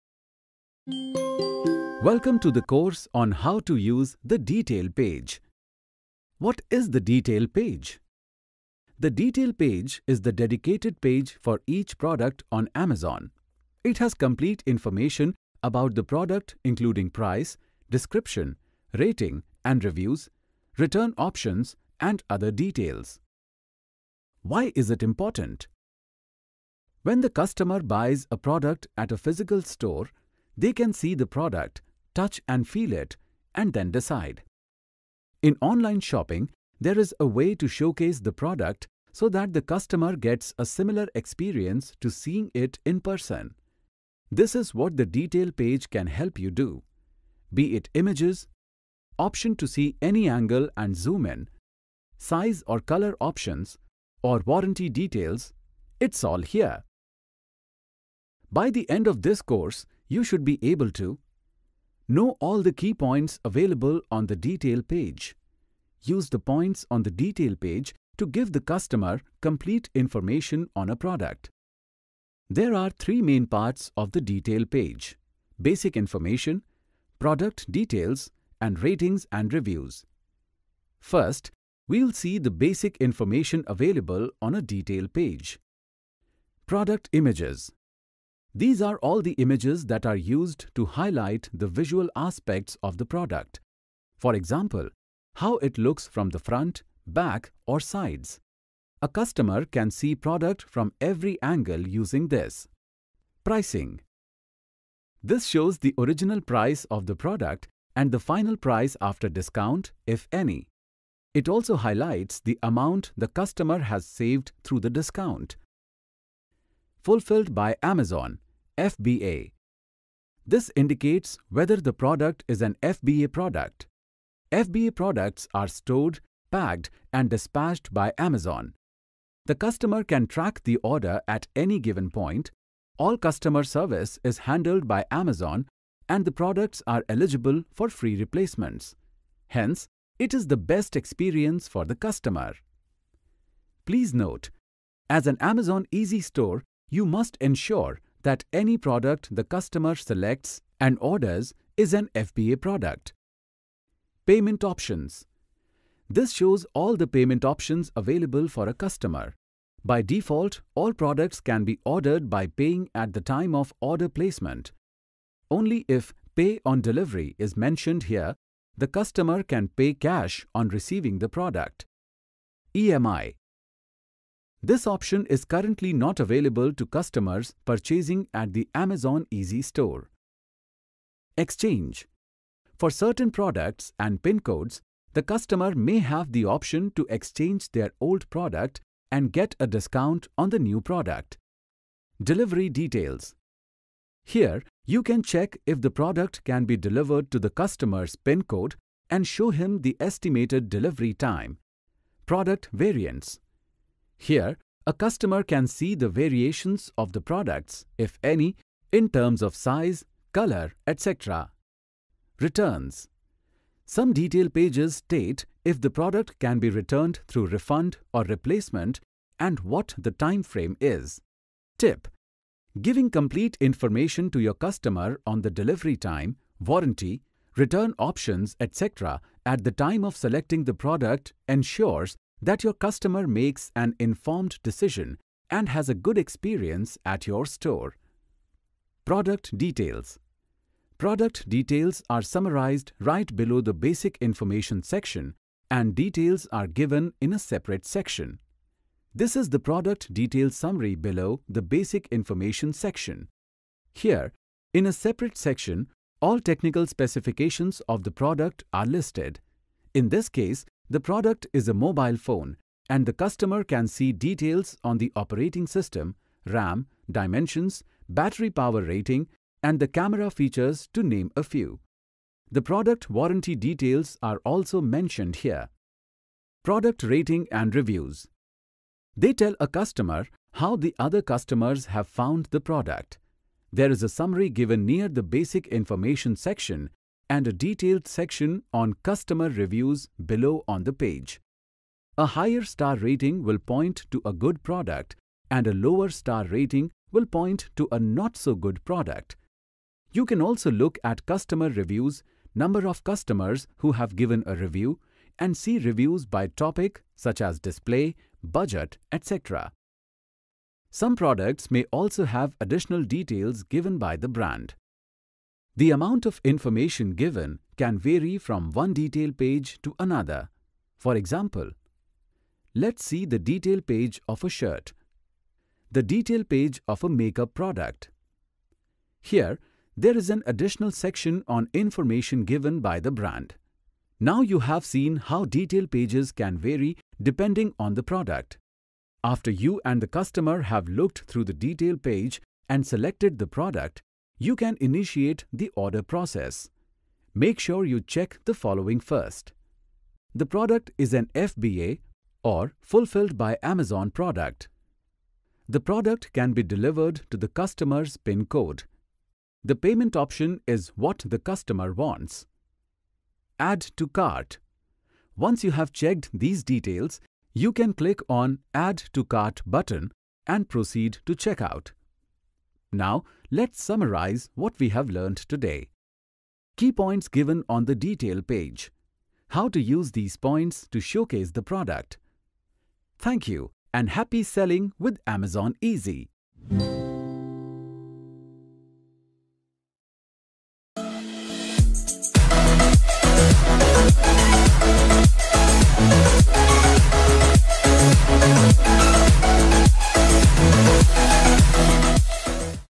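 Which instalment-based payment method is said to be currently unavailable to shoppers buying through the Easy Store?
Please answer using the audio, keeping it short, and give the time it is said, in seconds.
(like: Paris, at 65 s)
EMI, at 172 s.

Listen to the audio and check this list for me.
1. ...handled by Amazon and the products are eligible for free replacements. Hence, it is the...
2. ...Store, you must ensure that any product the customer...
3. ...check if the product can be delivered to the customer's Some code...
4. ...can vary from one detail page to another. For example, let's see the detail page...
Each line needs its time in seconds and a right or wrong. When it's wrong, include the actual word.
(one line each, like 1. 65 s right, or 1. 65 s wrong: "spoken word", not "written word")
1. 134 s right
2. 146 s right
3. 195 s wrong: "PIN", not "Some"
4. 317 s right.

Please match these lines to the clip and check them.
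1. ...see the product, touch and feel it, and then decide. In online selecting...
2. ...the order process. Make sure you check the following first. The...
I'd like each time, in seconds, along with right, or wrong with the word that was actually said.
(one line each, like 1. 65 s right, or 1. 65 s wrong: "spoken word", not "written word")
1. 30 s wrong: "shopping", not "selecting"
2. 345 s right.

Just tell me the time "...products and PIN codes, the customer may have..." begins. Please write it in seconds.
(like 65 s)
183 s.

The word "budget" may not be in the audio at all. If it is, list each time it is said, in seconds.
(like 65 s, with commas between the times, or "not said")
308 s.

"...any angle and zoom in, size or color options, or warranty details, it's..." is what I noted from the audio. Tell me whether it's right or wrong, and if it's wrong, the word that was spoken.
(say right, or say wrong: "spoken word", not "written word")
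right.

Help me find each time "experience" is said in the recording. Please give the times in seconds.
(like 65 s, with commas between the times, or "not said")
41 s, 140 s, 236 s.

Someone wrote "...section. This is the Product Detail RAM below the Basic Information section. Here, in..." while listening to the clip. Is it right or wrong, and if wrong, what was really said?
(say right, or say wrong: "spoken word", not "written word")
wrong: "Summary", not "RAM".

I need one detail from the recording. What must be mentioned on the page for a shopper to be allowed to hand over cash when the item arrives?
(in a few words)
Pay on Delivery.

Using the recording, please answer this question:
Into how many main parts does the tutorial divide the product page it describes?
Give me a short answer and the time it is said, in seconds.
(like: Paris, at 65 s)
3, at 72 s.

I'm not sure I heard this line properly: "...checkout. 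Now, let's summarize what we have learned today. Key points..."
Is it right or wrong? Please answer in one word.
right.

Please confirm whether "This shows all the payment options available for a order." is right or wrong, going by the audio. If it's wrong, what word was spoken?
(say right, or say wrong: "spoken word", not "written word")
wrong: "customer", not "order".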